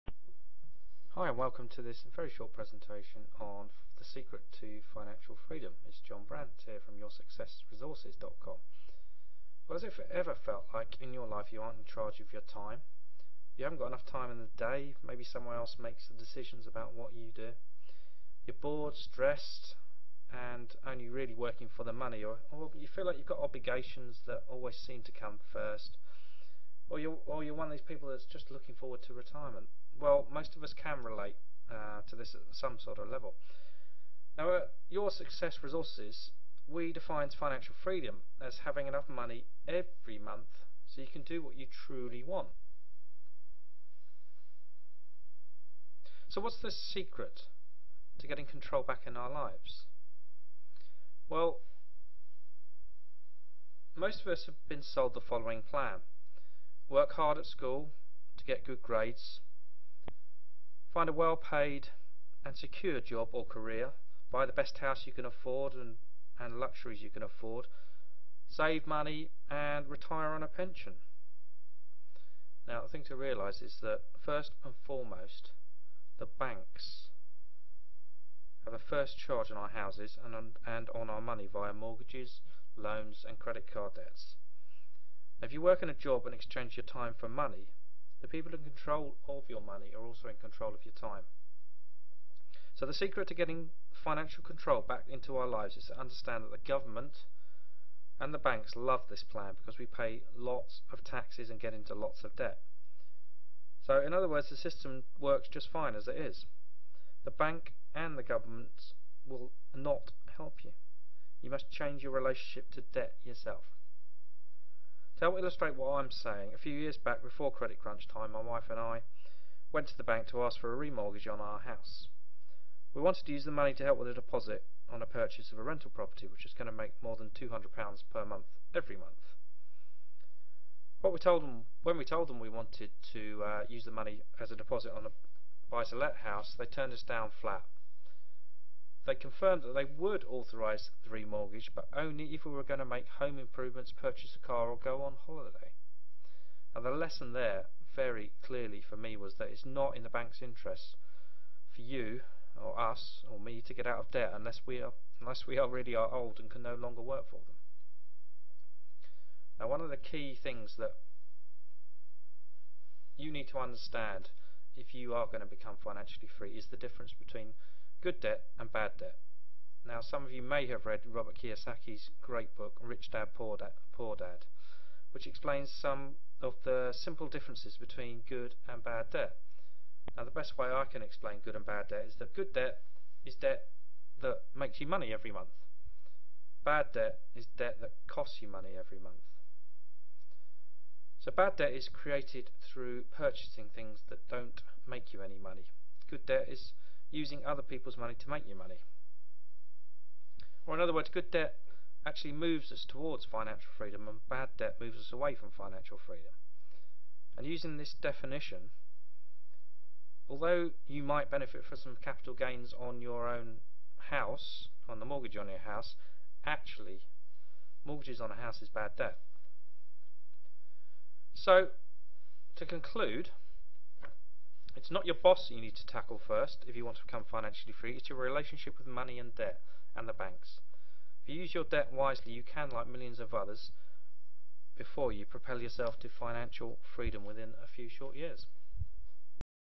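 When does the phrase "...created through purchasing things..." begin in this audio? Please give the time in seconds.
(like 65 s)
191 s.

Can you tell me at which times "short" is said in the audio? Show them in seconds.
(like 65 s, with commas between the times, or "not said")
2 s, 237 s.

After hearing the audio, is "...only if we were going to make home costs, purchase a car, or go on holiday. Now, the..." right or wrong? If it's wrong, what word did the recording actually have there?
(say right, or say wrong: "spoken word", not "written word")
wrong: "improvements", not "costs".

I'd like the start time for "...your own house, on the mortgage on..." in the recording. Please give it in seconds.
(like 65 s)
213 s.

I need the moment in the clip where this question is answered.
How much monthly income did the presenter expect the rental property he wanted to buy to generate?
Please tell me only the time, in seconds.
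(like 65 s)
127 s.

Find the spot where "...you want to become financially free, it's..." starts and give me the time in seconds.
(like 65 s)
226 s.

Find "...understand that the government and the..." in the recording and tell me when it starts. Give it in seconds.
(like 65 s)
95 s.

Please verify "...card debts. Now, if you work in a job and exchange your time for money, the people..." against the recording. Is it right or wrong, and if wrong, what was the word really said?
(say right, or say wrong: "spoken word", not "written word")
right.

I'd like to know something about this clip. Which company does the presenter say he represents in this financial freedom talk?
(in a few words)
YourSuccessResources.com.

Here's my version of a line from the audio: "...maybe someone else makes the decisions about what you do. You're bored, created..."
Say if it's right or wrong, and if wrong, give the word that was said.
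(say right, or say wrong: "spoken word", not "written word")
wrong: "stressed", not "created".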